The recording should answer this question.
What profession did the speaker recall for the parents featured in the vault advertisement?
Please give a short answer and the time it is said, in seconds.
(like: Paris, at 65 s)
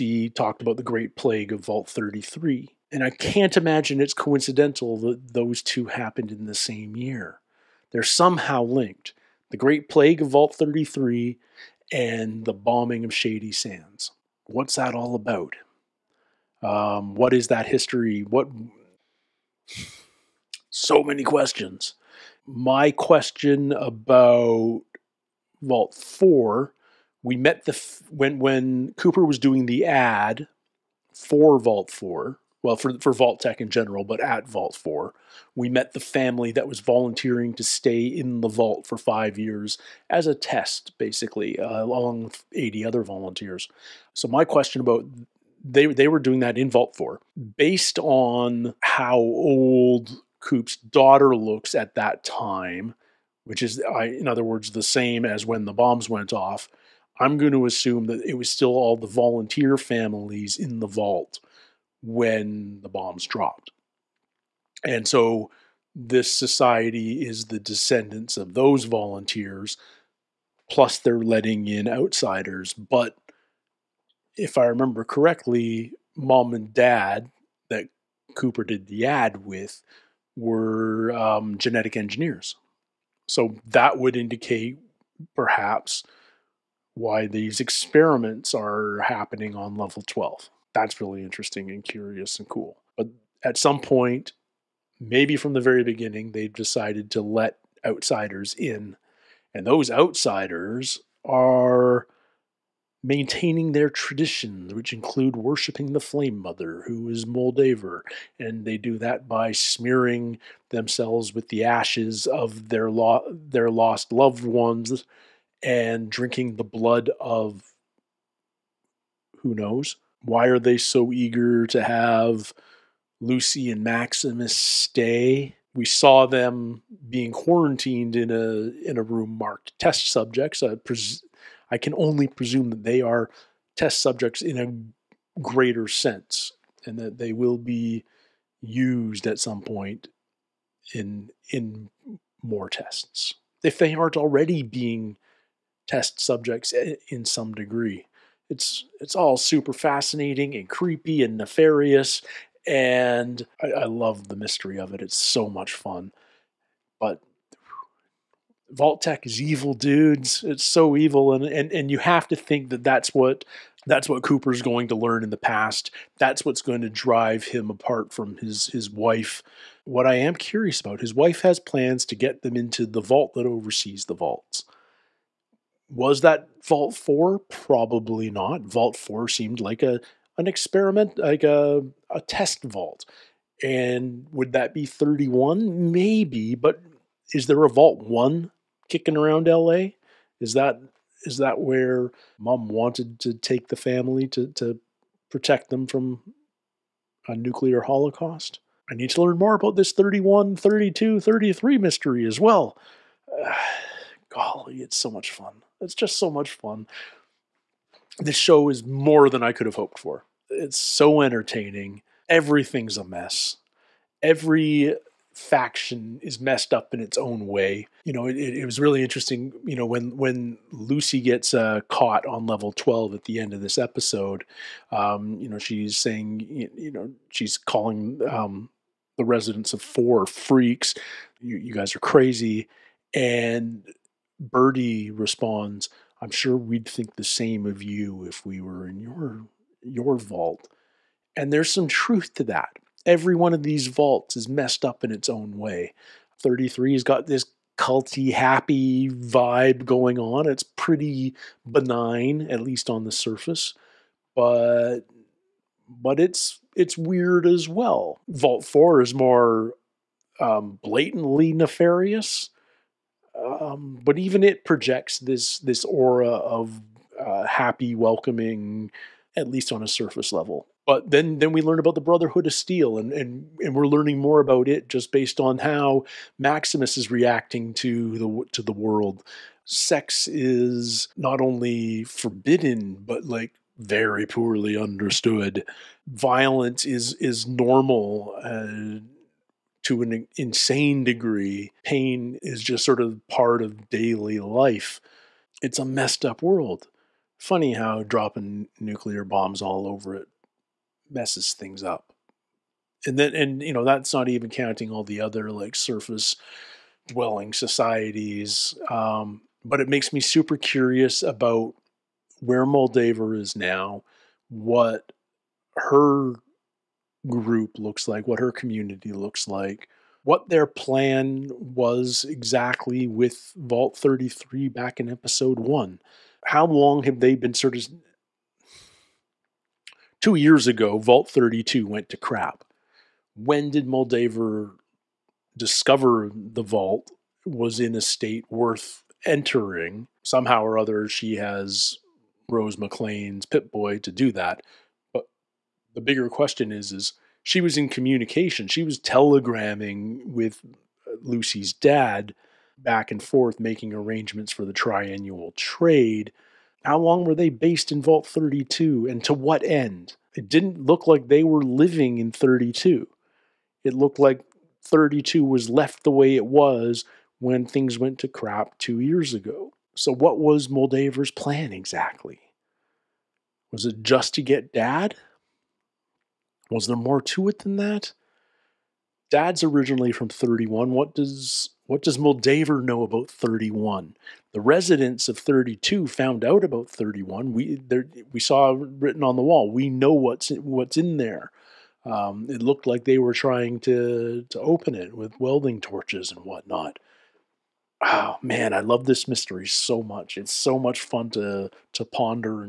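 Genetic engineers, at 81 s.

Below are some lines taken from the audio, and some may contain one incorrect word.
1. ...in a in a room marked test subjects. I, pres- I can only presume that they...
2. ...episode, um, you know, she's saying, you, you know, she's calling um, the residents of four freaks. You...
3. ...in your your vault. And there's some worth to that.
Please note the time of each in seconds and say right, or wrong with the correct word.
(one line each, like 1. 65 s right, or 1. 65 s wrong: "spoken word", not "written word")
1. 128 s right
2. 223 s right
3. 238 s wrong: "truth", not "worth".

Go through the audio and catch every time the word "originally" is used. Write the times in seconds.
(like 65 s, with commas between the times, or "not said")
379 s.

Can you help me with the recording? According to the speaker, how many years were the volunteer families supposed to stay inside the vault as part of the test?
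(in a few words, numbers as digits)
5.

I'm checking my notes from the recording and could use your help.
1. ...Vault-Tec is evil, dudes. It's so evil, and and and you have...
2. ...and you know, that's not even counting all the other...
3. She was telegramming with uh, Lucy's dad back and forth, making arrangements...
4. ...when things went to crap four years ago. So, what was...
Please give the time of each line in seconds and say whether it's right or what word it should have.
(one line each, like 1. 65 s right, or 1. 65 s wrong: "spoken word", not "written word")
1. 158 s right
2. 303 s right
3. 348 s right
4. 367 s wrong: "two", not "four".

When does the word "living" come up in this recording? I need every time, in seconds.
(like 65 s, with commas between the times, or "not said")
361 s.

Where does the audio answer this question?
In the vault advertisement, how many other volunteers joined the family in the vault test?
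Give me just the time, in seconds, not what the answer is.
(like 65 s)
42 s.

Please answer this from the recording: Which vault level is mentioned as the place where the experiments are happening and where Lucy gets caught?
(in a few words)
Level 12.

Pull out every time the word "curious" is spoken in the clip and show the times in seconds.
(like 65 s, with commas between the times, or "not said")
91 s, 170 s, 310 s.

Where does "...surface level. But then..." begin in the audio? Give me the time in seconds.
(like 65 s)
269 s.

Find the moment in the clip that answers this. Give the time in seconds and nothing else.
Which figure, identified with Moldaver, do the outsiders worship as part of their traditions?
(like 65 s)
105 s.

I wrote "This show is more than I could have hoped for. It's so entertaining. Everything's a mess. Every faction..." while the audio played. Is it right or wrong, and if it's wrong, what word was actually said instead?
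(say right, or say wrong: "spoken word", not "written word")
right.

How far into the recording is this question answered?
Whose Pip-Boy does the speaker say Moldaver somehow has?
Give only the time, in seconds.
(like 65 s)
342 s.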